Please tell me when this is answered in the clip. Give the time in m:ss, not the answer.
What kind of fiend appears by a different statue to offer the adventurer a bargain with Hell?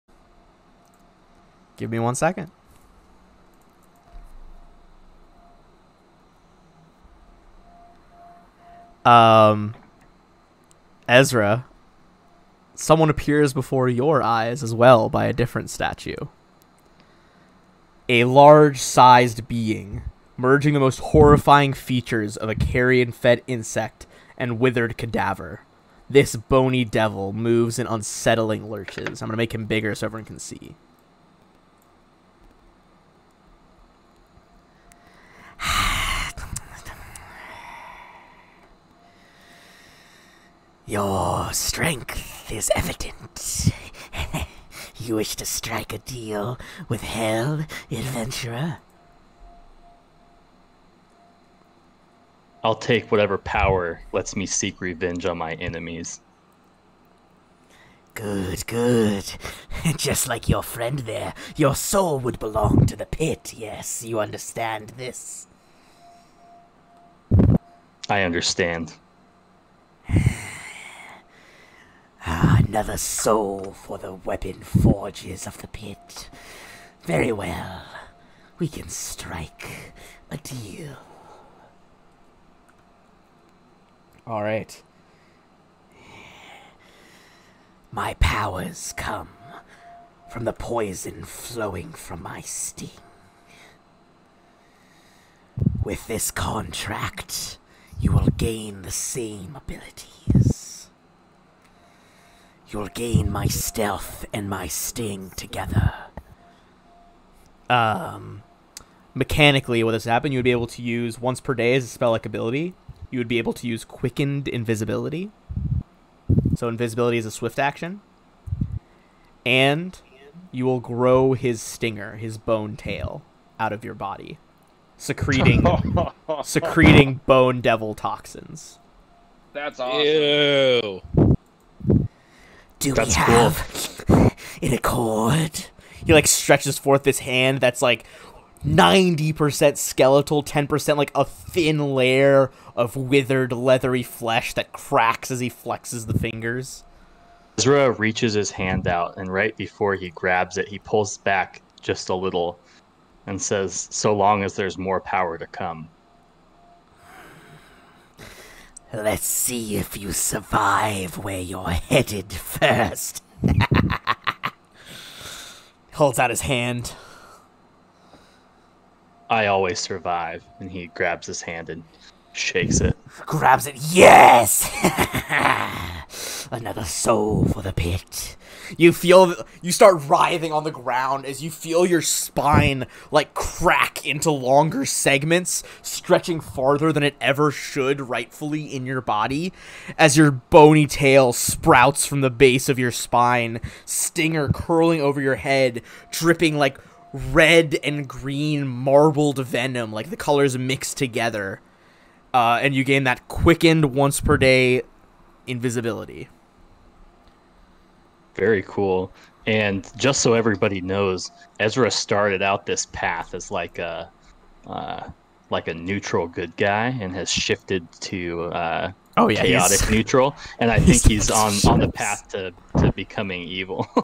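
0:26.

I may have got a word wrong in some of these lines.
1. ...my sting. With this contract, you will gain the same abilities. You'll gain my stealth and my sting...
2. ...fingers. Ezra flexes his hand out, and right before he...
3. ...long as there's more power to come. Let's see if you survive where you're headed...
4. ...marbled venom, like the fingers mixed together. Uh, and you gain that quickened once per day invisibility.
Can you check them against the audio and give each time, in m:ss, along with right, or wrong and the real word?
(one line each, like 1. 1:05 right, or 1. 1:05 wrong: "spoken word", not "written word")
1. 1:32 right
2. 2:26 wrong: "reaches", not "flexes"
3. 2:34 right
4. 3:18 wrong: "colors", not "fingers".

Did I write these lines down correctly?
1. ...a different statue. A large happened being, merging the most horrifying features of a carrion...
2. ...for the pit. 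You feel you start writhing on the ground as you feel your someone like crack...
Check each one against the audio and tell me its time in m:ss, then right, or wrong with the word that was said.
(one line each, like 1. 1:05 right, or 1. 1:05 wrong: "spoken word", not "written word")
1. 0:15 wrong: "sized", not "happened"
2. 2:57 wrong: "spine", not "someone".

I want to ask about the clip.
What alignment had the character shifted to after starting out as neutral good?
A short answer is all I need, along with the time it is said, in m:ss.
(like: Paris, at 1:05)
Chaotic neutral, at 3:39.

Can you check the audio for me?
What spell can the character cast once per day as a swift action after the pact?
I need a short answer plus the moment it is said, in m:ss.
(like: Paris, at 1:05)
Quickened invisibility, at 1:53.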